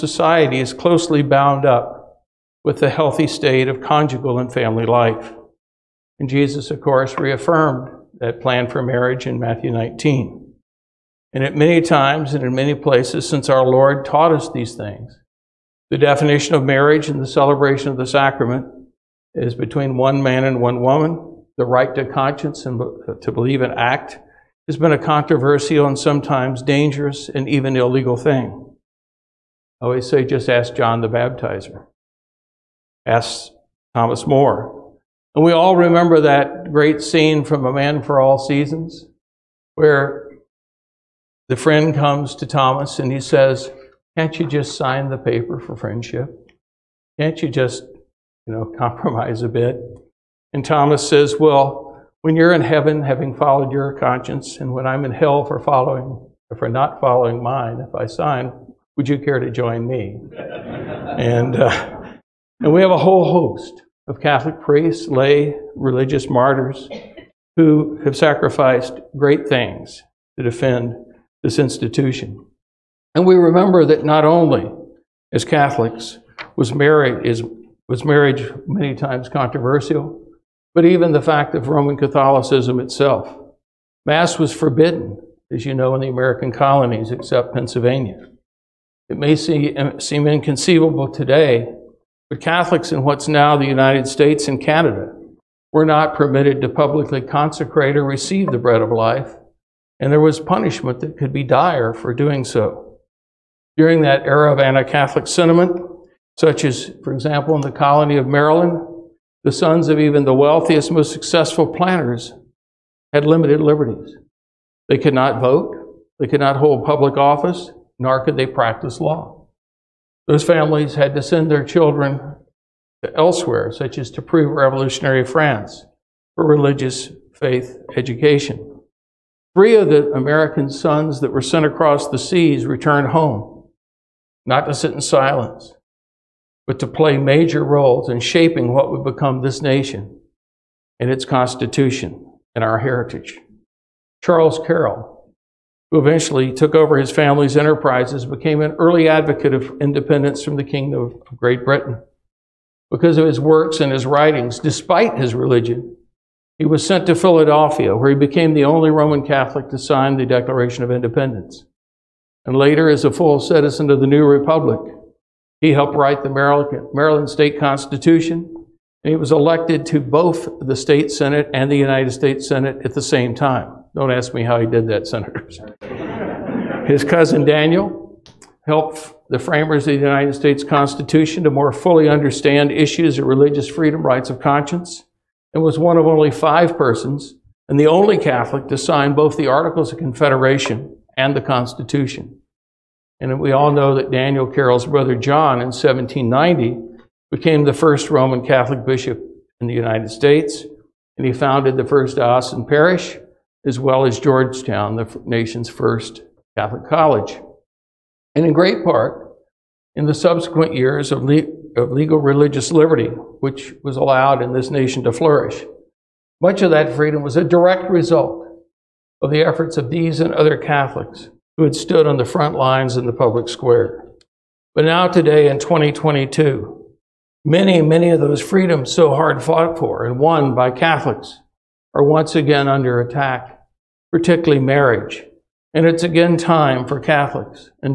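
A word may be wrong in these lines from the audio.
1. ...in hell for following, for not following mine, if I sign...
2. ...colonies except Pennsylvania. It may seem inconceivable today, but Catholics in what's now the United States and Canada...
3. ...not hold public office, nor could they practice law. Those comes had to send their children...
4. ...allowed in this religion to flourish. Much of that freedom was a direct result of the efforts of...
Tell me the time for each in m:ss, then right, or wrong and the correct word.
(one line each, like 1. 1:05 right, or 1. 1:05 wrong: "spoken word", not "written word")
1. 0:55 right
2. 1:26 right
3. 1:56 wrong: "families", not "comes"
4. 3:33 wrong: "nation", not "religion".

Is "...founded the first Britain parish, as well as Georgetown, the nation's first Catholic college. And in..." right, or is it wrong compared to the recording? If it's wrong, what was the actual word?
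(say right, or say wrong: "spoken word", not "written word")
wrong: "Austin", not "Britain".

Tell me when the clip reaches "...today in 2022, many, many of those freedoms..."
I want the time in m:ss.
3:45.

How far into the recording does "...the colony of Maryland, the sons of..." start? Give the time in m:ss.
1:47.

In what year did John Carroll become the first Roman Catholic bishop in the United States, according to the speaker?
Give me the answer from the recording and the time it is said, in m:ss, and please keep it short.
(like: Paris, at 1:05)
1790, at 3:15.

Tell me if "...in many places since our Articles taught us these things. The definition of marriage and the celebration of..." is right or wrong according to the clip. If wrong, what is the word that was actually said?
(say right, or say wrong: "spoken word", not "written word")
wrong: "Lord", not "Articles".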